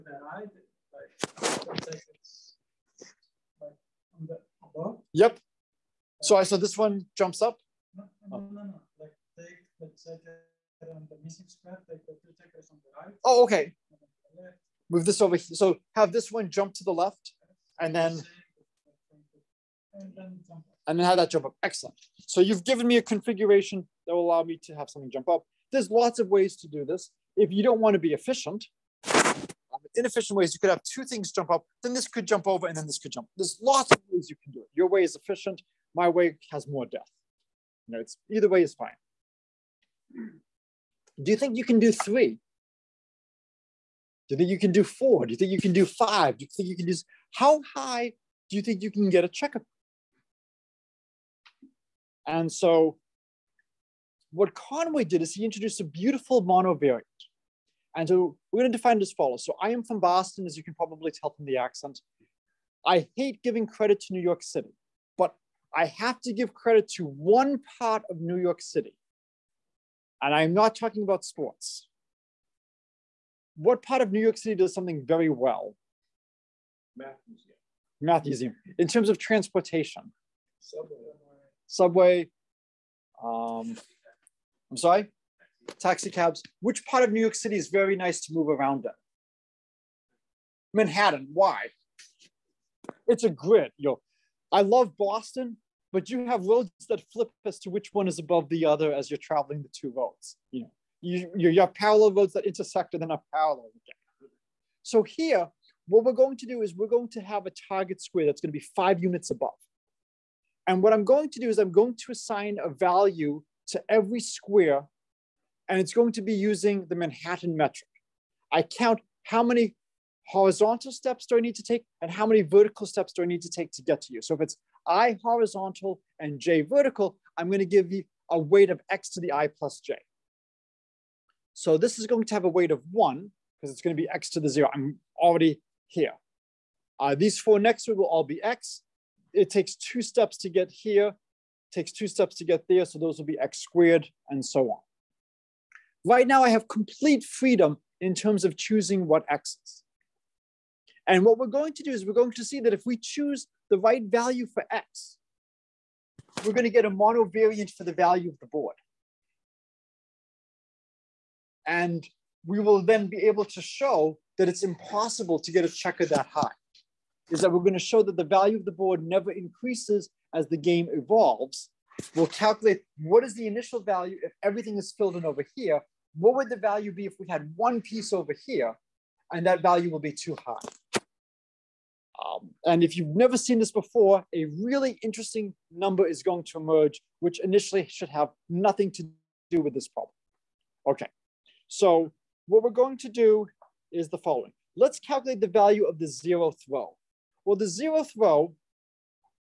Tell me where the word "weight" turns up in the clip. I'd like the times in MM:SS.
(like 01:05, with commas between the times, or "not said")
02:08, 02:12.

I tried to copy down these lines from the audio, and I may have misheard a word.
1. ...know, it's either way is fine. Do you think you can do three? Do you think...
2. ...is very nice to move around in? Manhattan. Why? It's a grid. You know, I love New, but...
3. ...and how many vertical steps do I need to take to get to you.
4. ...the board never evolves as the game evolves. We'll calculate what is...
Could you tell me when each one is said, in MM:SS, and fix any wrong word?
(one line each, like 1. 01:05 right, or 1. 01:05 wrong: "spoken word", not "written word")
1. 00:37 right
2. 01:27 wrong: "Boston", not "New"
3. 02:02 right
4. 02:48 wrong: "increases", not "evolves".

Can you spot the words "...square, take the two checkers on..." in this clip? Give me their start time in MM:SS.
00:11.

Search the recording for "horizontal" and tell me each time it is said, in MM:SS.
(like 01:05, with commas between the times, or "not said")
02:00, 02:05.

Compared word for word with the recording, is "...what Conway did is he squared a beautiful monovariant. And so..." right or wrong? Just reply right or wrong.
wrong.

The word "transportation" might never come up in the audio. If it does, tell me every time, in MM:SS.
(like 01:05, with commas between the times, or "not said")
01:19.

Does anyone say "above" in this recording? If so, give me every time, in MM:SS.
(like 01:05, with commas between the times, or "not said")
00:04, 01:38, 01:49.